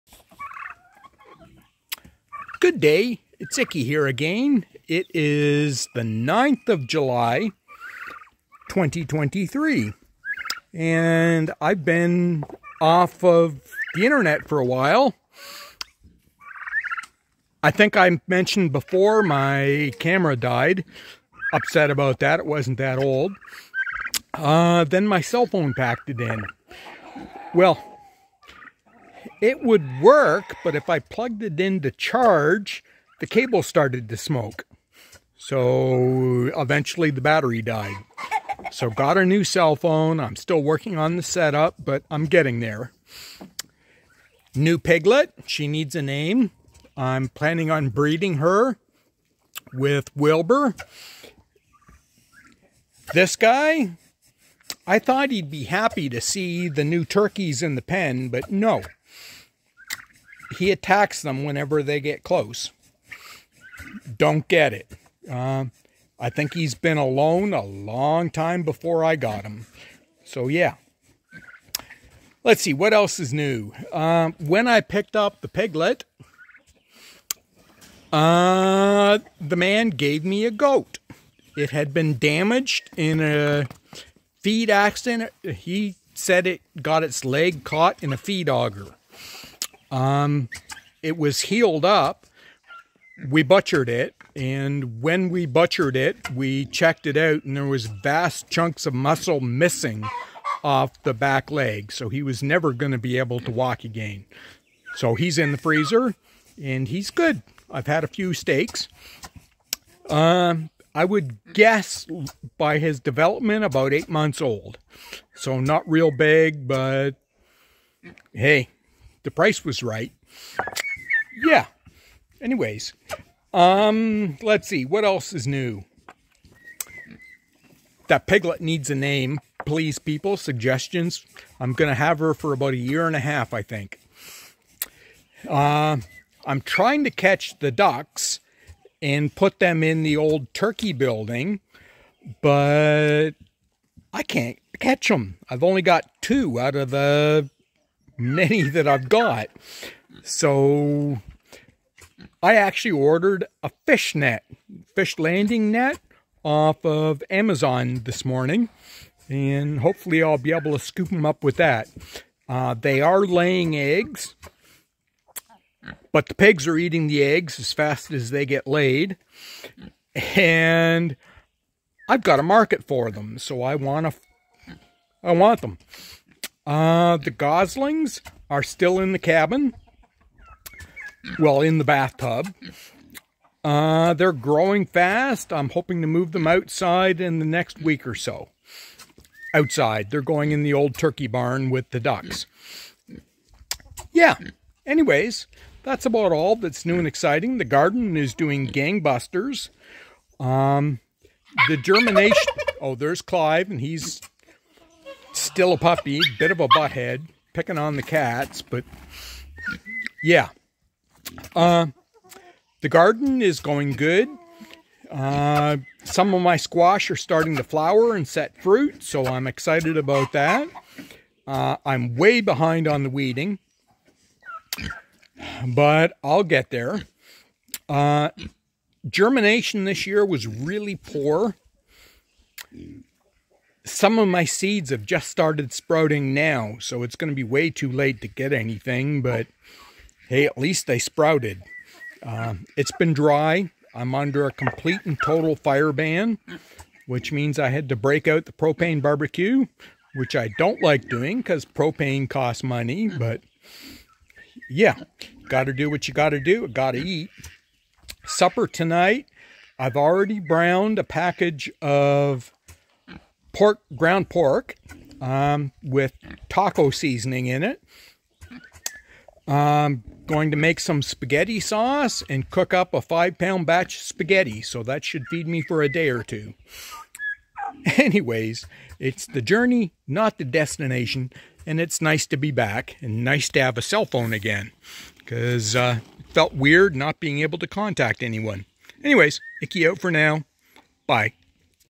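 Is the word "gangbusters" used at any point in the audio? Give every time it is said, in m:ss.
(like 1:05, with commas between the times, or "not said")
3:18.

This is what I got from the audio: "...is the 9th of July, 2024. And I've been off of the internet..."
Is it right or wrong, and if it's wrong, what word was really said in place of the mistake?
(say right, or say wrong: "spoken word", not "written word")
wrong: "2023", not "2024".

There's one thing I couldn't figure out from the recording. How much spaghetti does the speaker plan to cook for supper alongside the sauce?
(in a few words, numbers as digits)
5 pounds.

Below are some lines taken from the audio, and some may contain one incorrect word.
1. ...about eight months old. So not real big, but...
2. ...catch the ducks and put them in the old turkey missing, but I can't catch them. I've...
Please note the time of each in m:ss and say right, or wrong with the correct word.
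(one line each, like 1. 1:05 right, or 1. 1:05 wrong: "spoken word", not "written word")
1. 1:53 right
2. 2:17 wrong: "building", not "missing".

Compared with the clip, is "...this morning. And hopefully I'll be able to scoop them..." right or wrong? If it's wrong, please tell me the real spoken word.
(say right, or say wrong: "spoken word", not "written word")
right.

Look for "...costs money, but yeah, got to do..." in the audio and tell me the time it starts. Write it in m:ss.
4:12.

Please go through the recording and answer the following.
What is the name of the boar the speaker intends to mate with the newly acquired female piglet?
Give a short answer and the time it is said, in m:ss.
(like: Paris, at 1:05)
Wilbur, at 0:50.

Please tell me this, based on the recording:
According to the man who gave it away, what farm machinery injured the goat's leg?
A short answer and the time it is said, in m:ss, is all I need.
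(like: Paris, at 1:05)
feed auger, at 1:28.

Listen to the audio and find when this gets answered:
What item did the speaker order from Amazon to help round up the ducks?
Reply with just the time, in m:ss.
2:34.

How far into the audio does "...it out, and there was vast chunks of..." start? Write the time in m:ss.
1:37.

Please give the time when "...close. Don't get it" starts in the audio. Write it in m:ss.
1:02.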